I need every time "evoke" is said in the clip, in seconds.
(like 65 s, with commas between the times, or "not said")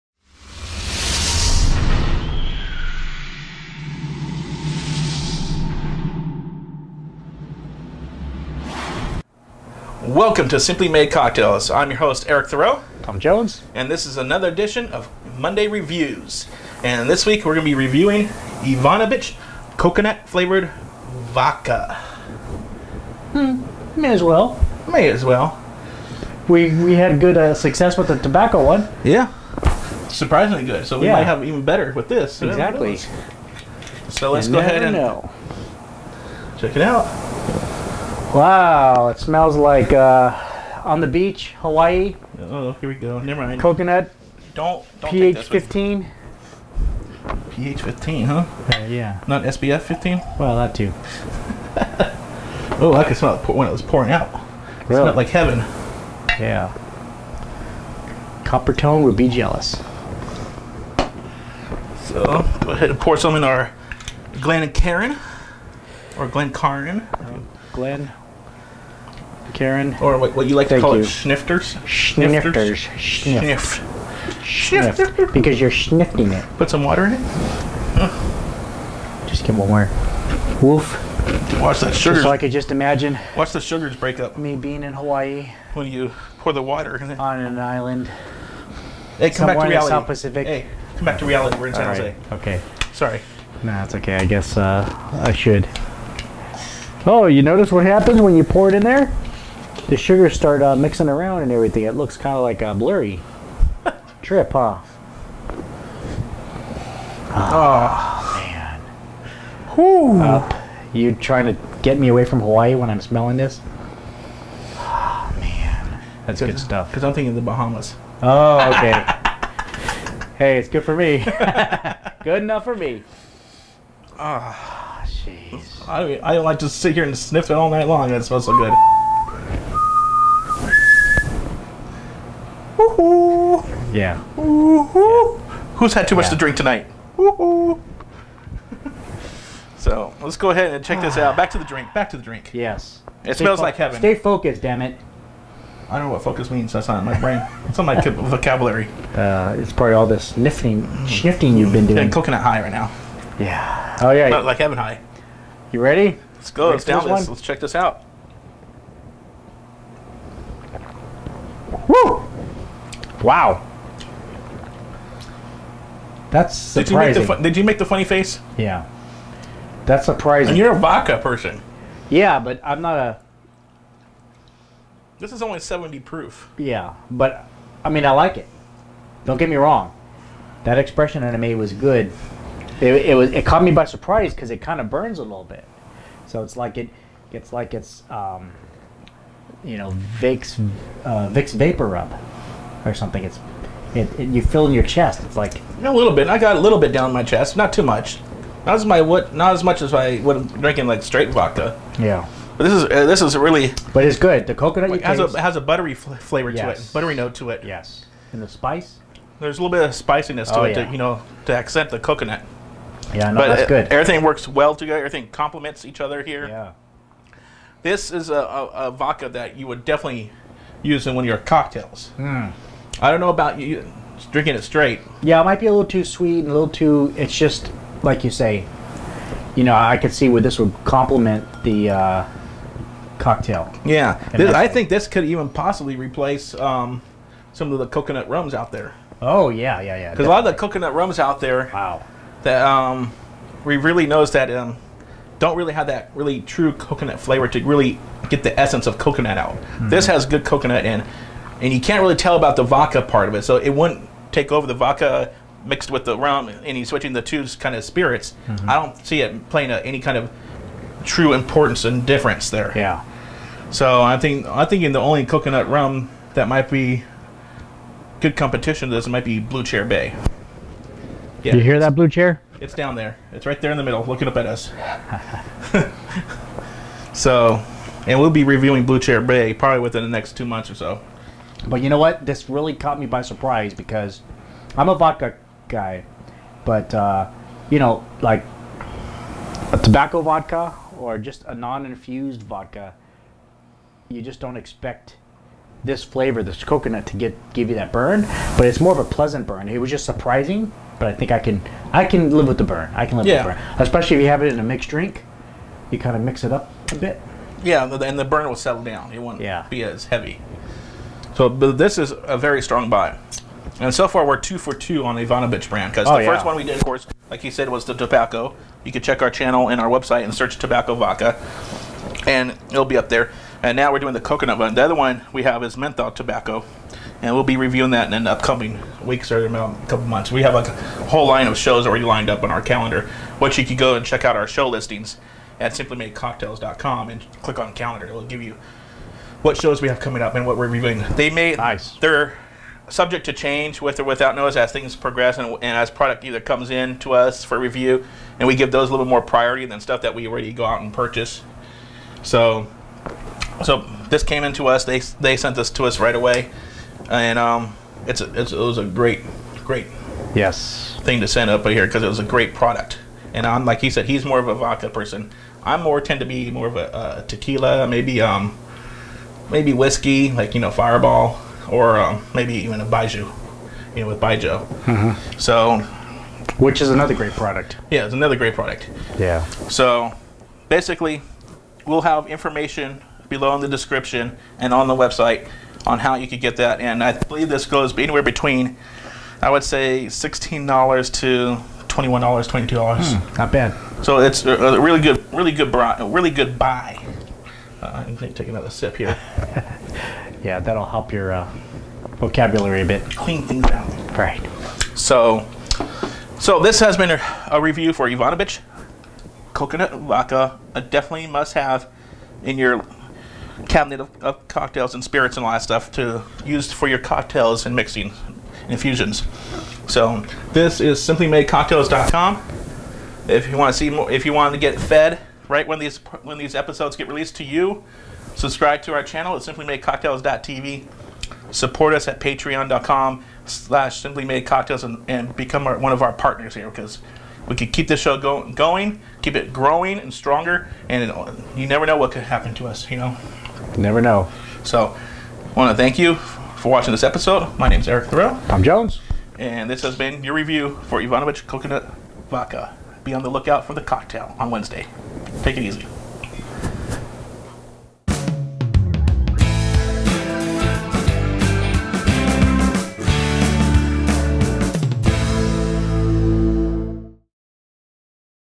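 not said.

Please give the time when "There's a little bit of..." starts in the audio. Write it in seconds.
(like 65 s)
209 s.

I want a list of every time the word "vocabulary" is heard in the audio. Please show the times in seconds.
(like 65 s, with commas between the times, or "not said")
147 s, 402 s.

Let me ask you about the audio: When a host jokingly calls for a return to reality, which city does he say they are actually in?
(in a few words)
San Jose.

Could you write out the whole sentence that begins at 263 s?
So I think I think in the only coconut rum that might be good competition to this might be Blue Chair Bay.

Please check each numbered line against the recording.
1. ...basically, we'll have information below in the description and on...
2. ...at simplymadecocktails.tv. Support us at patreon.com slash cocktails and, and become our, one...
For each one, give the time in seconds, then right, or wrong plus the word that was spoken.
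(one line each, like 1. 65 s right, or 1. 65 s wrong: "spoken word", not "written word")
1. 380 s right
2. 429 s wrong: "simplymadecocktails", not "cocktails".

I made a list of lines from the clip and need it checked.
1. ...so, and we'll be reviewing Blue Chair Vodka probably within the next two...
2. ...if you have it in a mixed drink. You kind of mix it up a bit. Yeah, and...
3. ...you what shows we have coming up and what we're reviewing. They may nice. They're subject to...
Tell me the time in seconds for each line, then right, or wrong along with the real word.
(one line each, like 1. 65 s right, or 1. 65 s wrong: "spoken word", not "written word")
1. 277 s wrong: "Bay", not "Vodka"
2. 304 s right
3. 338 s right.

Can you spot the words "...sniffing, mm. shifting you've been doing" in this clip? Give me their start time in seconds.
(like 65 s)
150 s.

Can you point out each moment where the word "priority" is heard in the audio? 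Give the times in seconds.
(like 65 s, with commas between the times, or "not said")
349 s.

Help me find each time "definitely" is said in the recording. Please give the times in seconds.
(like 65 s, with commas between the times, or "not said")
219 s, 410 s.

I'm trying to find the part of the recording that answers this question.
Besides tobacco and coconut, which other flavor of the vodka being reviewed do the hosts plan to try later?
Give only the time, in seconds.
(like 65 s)
325 s.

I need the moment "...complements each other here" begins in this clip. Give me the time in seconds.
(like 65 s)
215 s.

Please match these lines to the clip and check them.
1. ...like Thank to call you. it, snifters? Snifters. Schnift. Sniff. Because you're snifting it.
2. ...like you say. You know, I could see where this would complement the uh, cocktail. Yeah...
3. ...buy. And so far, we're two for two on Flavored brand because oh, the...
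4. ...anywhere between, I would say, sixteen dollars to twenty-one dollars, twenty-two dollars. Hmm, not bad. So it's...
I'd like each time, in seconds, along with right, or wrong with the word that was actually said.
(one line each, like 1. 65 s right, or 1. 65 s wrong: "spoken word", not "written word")
1. 70 s right
2. 228 s right
3. 312 s wrong: "Ivanabitch", not "Flavored"
4. 387 s right.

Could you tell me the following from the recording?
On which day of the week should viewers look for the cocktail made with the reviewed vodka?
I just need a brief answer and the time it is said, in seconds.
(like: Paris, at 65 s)
Wednesday, at 454 s.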